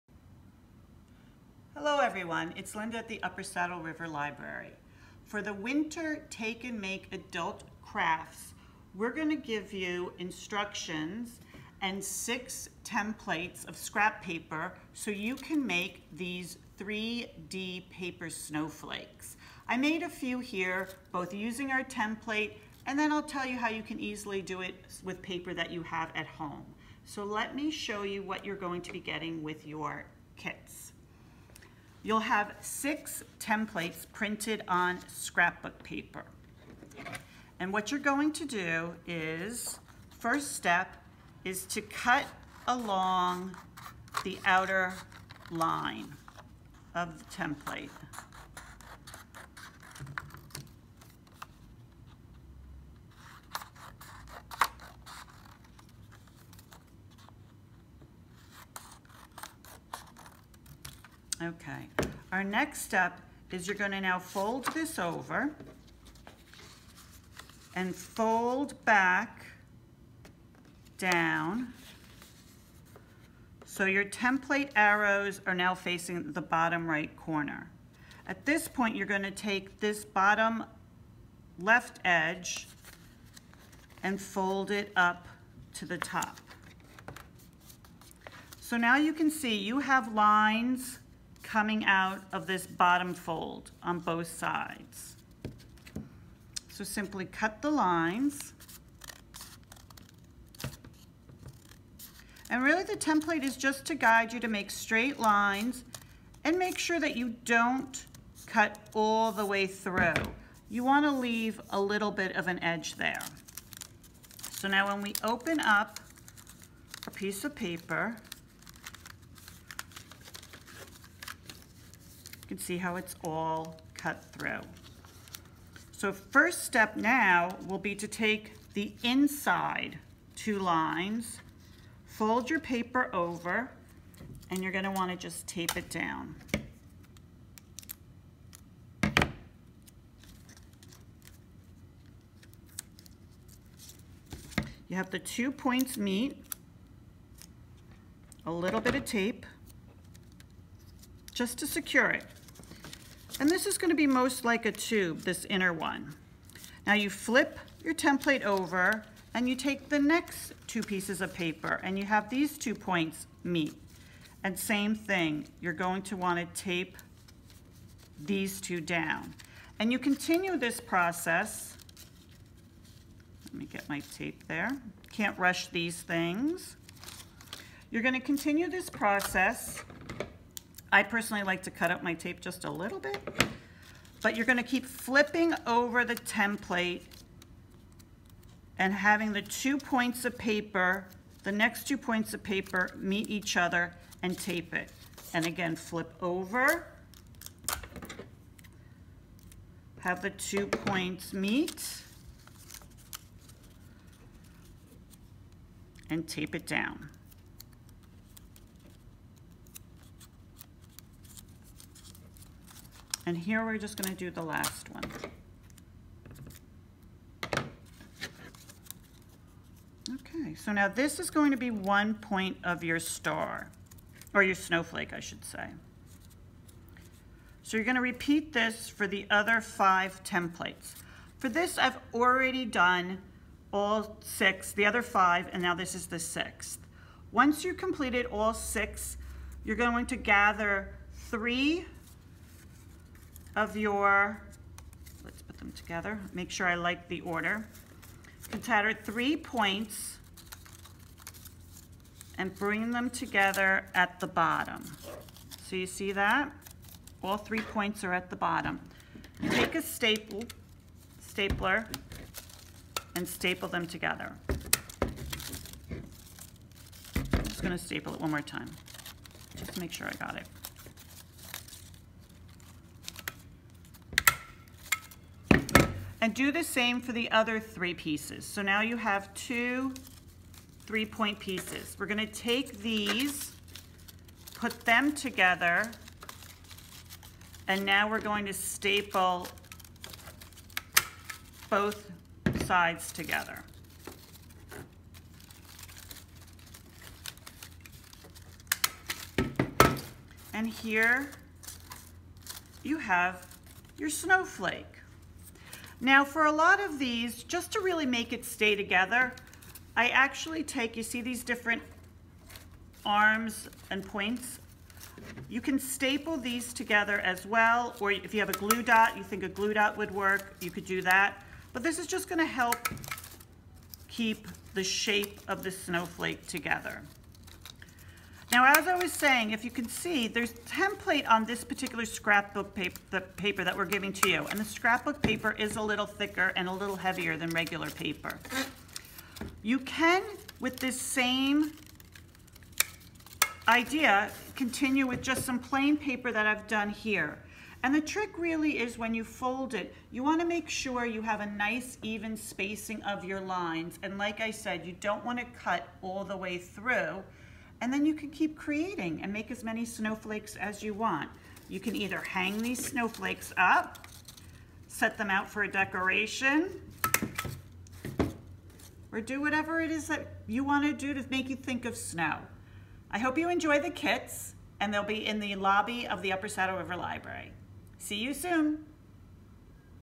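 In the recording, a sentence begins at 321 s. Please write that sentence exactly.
But this is just gonna help keep the shape of the snowflake together.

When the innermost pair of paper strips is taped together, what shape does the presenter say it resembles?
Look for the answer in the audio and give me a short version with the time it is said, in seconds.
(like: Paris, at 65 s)
a tube, at 154 s.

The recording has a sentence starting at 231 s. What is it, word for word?
For this, I've already done all six, the other five, and now this is the sixth.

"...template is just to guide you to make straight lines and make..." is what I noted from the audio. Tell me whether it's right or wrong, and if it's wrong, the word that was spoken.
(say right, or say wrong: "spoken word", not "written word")
right.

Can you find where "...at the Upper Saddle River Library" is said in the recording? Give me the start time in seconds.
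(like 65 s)
2 s.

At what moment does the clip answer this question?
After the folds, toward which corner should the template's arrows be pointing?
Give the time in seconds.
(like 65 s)
76 s.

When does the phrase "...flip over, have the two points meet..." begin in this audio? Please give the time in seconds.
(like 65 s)
195 s.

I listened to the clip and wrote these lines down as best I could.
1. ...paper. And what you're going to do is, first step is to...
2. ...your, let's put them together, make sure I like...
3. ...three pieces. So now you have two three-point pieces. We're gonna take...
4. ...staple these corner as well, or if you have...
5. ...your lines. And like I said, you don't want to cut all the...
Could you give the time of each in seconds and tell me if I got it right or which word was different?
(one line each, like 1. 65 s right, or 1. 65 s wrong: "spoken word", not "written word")
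1. 35 s right
2. 243 s right
3. 277 s right
4. 315 s wrong: "together", not "corner"
5. 353 s right.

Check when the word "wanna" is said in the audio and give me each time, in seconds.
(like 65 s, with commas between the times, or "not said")
134 s, 166 s.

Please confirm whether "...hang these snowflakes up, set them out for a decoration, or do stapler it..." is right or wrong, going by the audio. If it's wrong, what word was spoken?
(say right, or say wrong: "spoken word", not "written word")
wrong: "whatever", not "stapler".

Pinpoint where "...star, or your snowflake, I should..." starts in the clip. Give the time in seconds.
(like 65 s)
222 s.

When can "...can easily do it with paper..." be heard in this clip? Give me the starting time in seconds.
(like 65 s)
23 s.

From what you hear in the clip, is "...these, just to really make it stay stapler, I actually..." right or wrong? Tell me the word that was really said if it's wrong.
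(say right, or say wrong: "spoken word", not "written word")
wrong: "together", not "stapler".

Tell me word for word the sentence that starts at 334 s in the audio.
And the scrapbook paper is a little thicker and a little heavier than regular paper.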